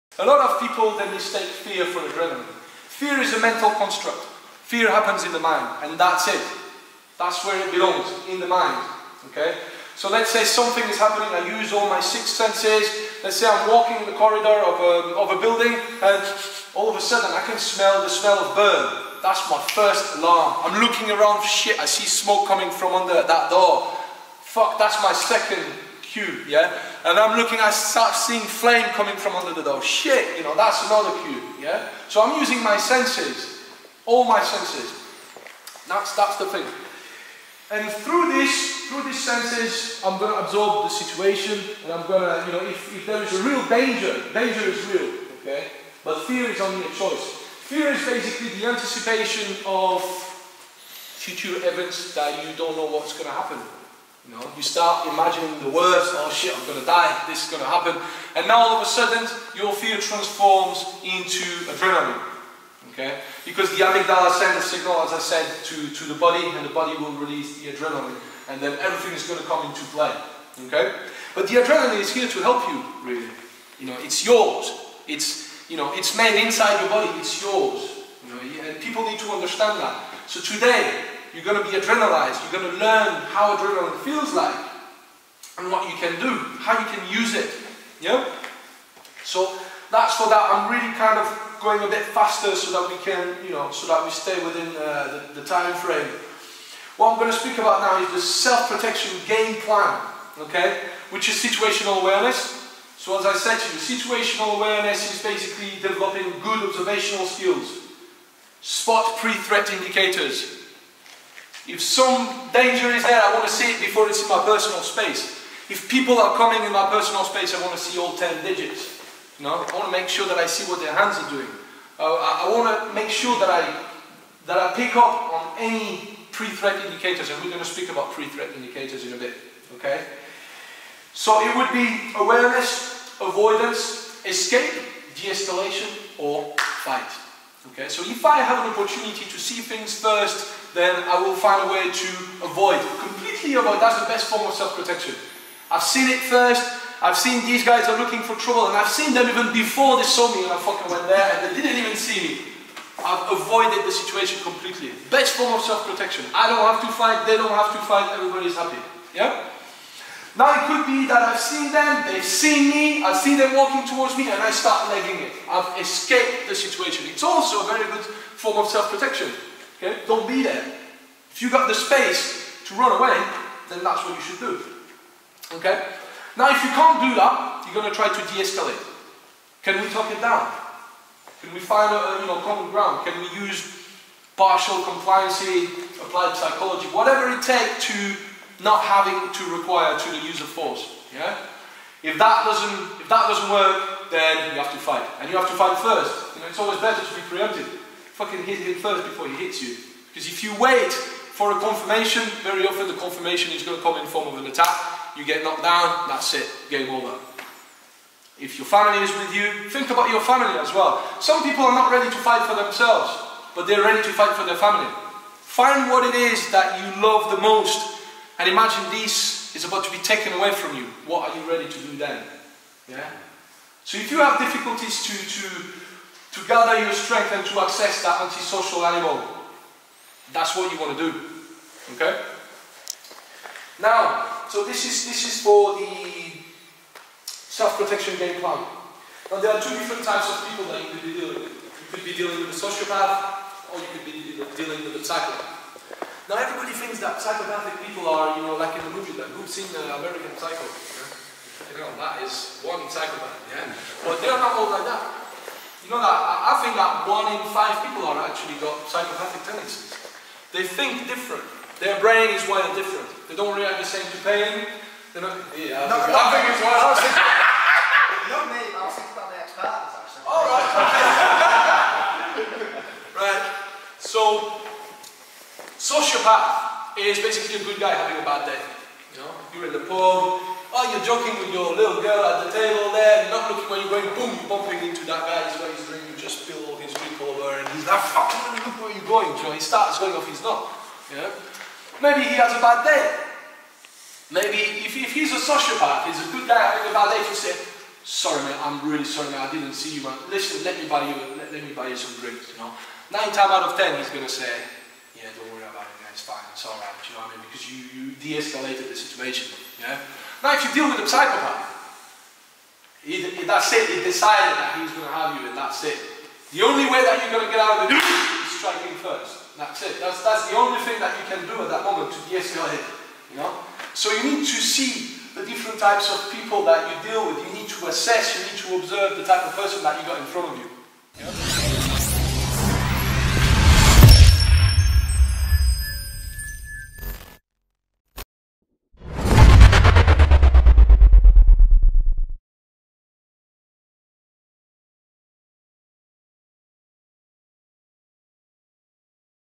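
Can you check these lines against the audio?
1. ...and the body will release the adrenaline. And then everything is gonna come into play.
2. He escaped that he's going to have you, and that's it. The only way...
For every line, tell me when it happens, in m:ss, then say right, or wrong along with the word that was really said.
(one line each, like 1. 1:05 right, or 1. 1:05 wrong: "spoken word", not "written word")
1. 1:06 right
2. 5:13 wrong: "decided", not "escaped".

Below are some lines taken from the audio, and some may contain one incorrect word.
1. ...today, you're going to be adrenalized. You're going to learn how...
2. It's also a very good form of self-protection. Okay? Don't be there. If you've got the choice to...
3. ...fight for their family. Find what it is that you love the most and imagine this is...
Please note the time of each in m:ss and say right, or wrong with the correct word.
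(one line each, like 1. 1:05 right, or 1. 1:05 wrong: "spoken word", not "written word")
1. 1:20 right
2. 2:47 wrong: "space", not "choice"
3. 3:34 right.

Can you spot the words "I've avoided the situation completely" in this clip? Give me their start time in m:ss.
2:33.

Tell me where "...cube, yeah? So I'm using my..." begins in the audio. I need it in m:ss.
0:31.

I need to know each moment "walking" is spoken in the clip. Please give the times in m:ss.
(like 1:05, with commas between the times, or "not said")
0:13, 2:43.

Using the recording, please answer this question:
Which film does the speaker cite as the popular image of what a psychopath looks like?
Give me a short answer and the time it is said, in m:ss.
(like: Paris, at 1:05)
American Psycho, at 4:09.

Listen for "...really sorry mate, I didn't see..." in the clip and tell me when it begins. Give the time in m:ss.
4:58.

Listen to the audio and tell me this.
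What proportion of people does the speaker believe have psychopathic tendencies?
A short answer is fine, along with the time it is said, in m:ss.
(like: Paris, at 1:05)
One in five, at 4:17.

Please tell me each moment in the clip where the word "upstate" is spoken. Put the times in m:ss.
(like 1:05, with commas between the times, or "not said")
not said.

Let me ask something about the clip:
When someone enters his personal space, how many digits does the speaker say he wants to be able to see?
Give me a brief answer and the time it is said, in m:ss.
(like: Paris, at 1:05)
10, at 1:58.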